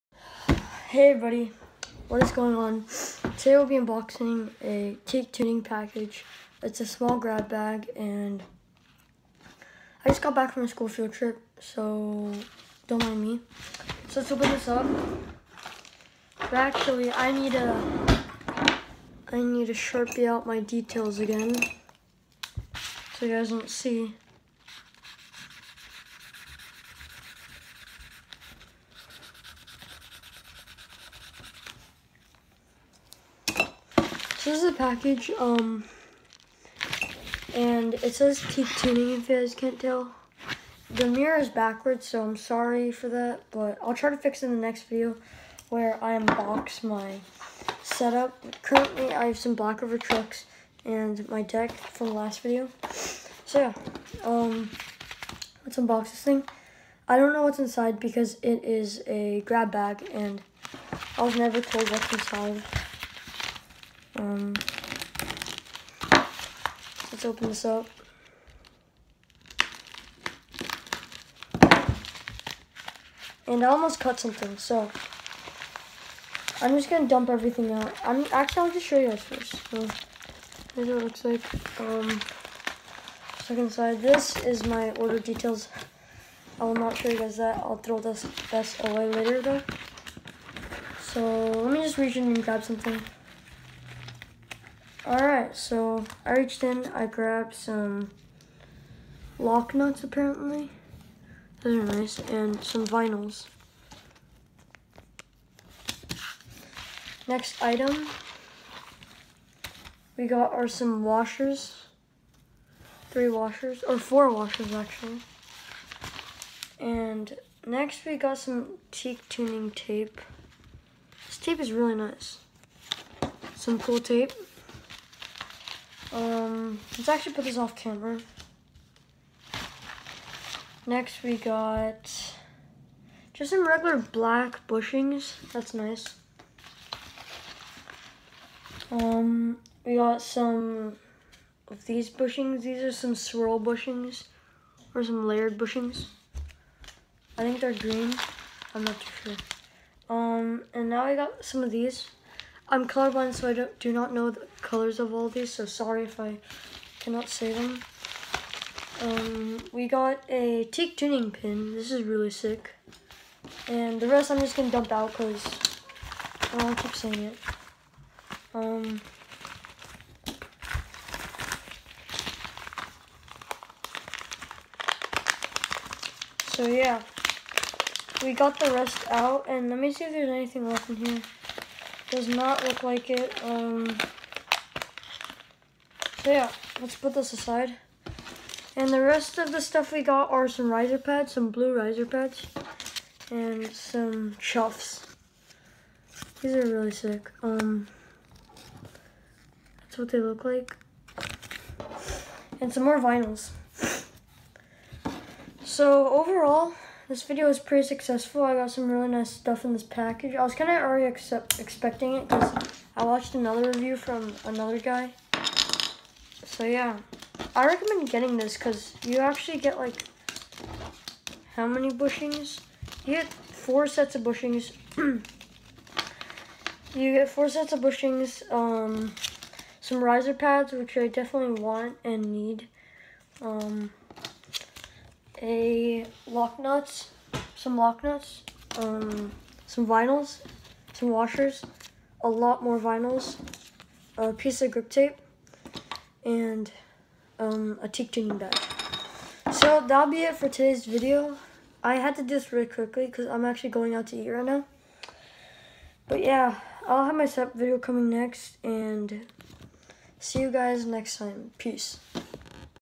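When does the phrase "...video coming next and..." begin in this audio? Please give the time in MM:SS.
04:17.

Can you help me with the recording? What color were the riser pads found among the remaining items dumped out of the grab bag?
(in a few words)
Blue.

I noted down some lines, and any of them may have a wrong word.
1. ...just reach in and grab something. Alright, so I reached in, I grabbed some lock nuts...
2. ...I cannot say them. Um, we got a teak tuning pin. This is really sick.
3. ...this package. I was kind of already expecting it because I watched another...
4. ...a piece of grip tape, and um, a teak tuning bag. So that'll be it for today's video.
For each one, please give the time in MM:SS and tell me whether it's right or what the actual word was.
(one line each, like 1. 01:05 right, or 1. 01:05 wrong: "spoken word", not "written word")
1. 01:31 right
2. 02:36 right
3. 03:29 right
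4. 04:04 right.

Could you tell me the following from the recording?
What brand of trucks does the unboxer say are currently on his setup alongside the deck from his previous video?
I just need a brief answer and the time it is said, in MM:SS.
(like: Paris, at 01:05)
Blackriver, at 00:49.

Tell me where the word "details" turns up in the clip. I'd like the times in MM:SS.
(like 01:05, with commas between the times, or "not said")
00:20, 01:25.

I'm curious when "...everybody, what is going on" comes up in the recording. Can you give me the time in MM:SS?
00:01.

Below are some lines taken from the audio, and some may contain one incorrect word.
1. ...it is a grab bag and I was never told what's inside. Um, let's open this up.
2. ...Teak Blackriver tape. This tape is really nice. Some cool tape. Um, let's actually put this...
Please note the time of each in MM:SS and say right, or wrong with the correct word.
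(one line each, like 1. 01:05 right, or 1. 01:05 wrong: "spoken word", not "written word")
1. 00:58 right
2. 01:58 wrong: "Tuning", not "Blackriver".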